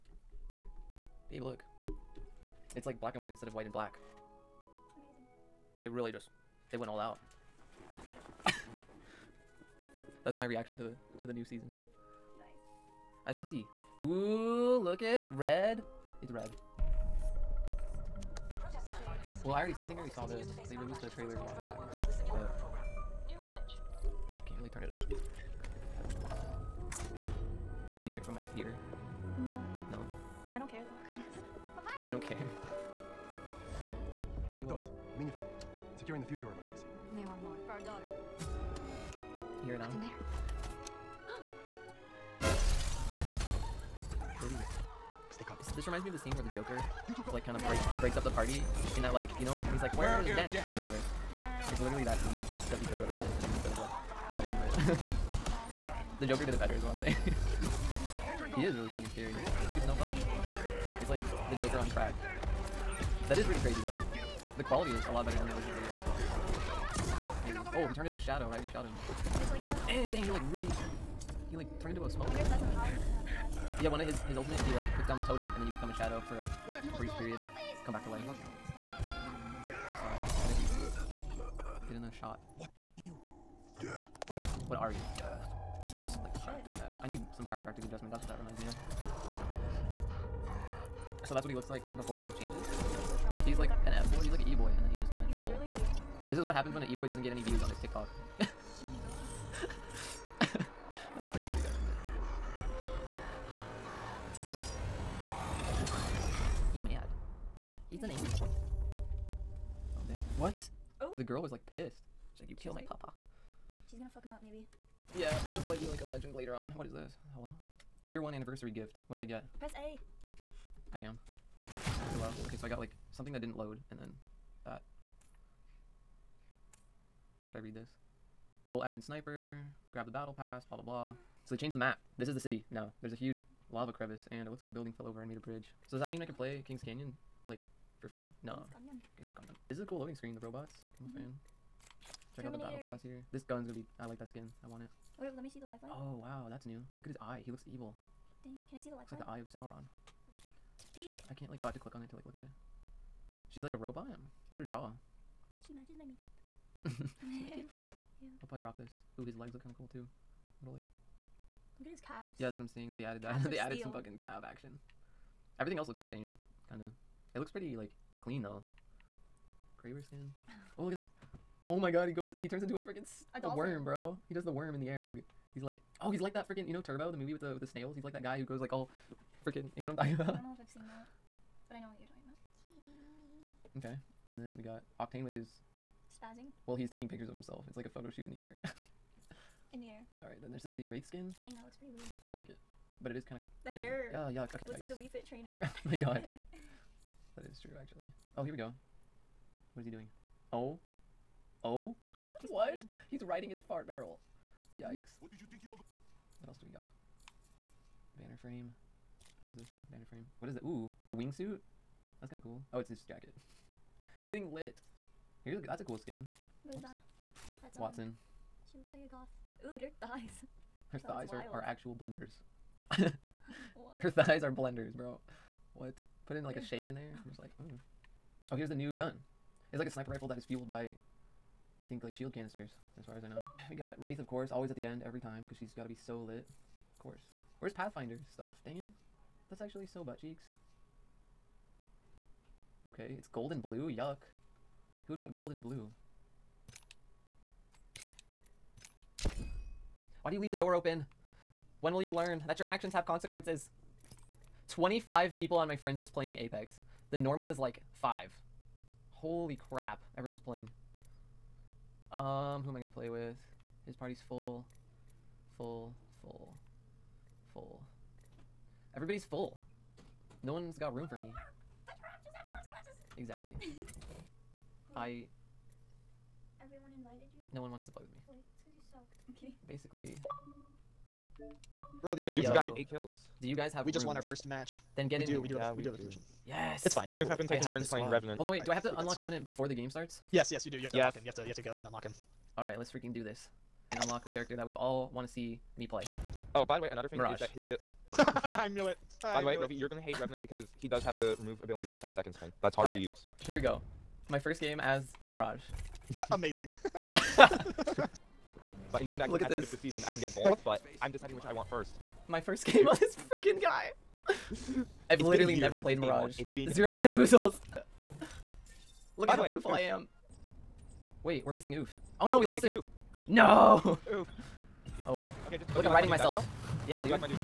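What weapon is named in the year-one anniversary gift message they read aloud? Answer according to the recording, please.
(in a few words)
Bolt action sniper.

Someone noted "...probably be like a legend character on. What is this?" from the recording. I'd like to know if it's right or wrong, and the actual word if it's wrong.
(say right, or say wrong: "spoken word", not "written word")
wrong: "later", not "character".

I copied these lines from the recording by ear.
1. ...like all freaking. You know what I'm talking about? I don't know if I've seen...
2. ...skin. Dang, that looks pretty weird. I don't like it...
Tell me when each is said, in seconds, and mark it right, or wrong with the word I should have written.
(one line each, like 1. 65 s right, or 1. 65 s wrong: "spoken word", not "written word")
1. 178 s right
2. 191 s right.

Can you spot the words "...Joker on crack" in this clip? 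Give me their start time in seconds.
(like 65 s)
61 s.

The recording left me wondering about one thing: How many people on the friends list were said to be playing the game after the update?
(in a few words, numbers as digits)
25.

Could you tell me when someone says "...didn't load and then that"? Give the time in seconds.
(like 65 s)
123 s.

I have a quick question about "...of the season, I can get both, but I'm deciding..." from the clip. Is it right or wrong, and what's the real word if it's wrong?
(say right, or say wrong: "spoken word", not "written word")
right.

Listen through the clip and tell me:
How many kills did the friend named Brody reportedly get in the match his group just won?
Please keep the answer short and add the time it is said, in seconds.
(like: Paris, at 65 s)
8, at 282 s.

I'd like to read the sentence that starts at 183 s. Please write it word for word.
Okay, and then we got Octane with his spazzing.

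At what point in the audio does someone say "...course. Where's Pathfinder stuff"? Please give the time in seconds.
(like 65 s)
237 s.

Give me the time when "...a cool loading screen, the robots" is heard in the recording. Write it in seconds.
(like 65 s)
139 s.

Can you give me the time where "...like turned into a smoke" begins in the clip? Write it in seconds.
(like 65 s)
71 s.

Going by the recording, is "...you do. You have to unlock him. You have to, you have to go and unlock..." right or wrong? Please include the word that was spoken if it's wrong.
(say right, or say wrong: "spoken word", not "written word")
right.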